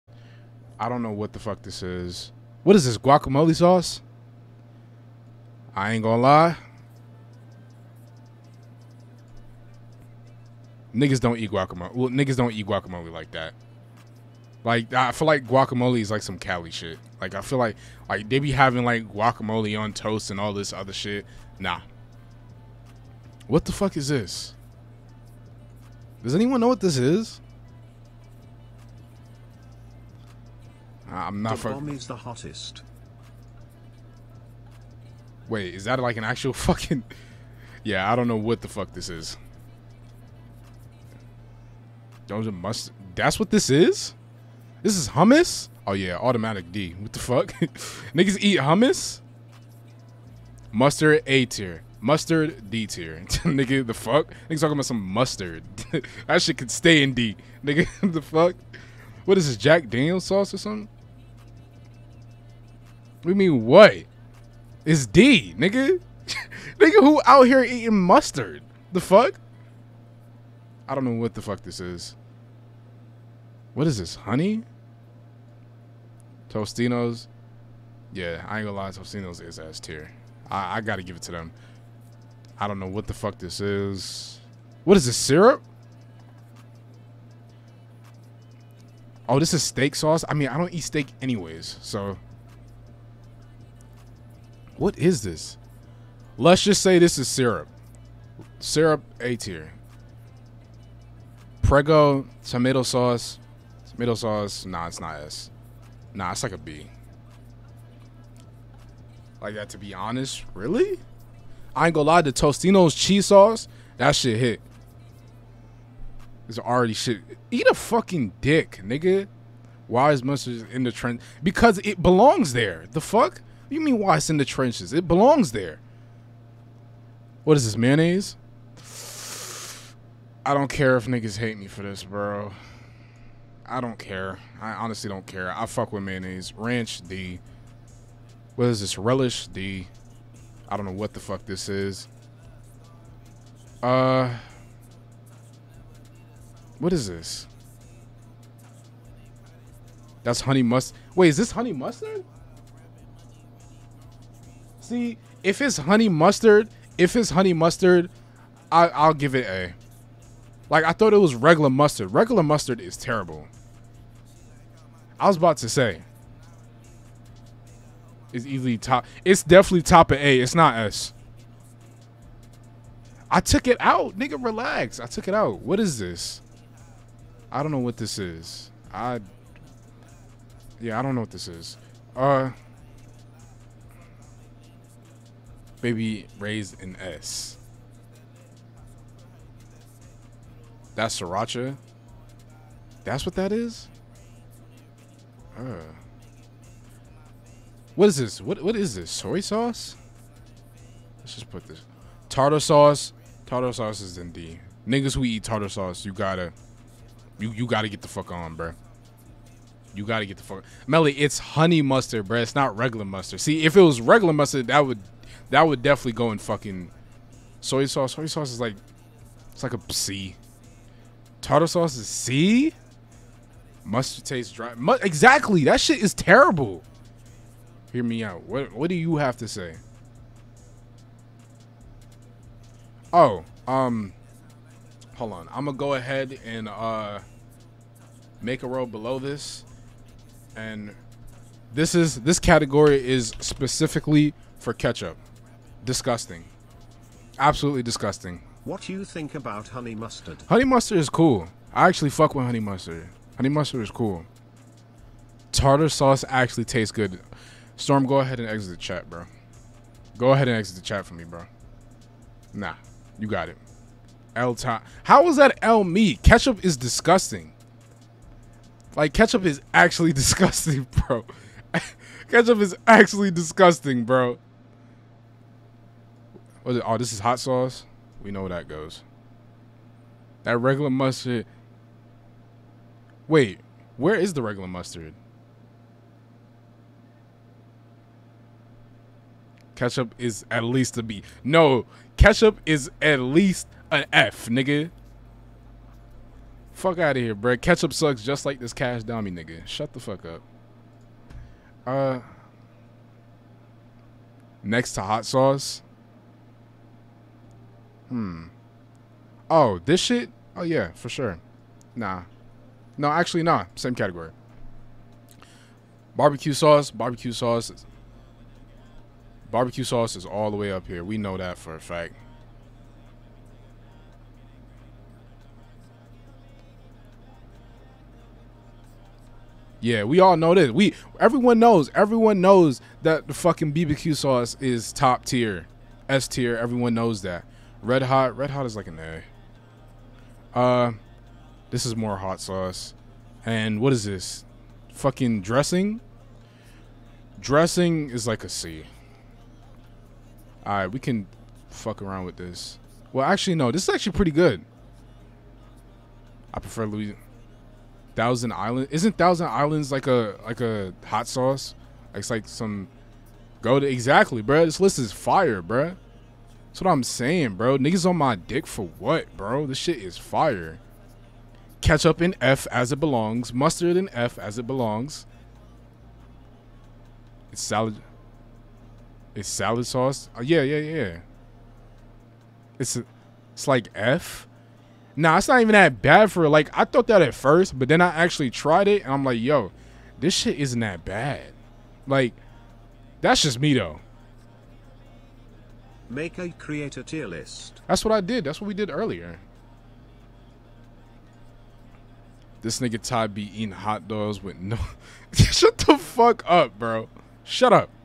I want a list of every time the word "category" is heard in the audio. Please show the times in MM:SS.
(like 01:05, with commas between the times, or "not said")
04:02, 05:13.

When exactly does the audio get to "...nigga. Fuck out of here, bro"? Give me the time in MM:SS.
04:54.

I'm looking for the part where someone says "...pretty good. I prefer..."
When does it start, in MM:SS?
05:54.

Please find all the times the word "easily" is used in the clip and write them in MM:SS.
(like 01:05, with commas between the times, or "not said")
02:48.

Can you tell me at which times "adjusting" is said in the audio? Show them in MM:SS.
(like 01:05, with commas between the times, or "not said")
not said.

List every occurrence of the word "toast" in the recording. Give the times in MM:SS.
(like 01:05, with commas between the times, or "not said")
00:19.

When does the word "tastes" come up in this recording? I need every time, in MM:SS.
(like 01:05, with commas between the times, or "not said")
03:44, 04:16.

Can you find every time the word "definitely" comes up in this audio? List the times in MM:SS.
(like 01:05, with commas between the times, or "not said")
02:49, 03:35.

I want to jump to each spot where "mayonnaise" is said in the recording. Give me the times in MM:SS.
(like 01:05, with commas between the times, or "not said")
02:07, 02:16.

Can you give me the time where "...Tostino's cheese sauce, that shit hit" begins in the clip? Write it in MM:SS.
01:52.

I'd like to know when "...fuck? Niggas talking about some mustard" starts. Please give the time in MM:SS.
00:53.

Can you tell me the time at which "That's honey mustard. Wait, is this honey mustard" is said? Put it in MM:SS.
02:30.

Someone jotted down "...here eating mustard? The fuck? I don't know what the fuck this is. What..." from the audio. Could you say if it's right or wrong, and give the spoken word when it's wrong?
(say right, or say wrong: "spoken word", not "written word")
right.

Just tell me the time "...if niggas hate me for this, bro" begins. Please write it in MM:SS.
02:10.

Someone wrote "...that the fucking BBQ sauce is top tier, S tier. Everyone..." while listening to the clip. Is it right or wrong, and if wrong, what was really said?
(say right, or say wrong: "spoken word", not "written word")
right.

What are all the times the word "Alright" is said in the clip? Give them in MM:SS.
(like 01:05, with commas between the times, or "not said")
05:50.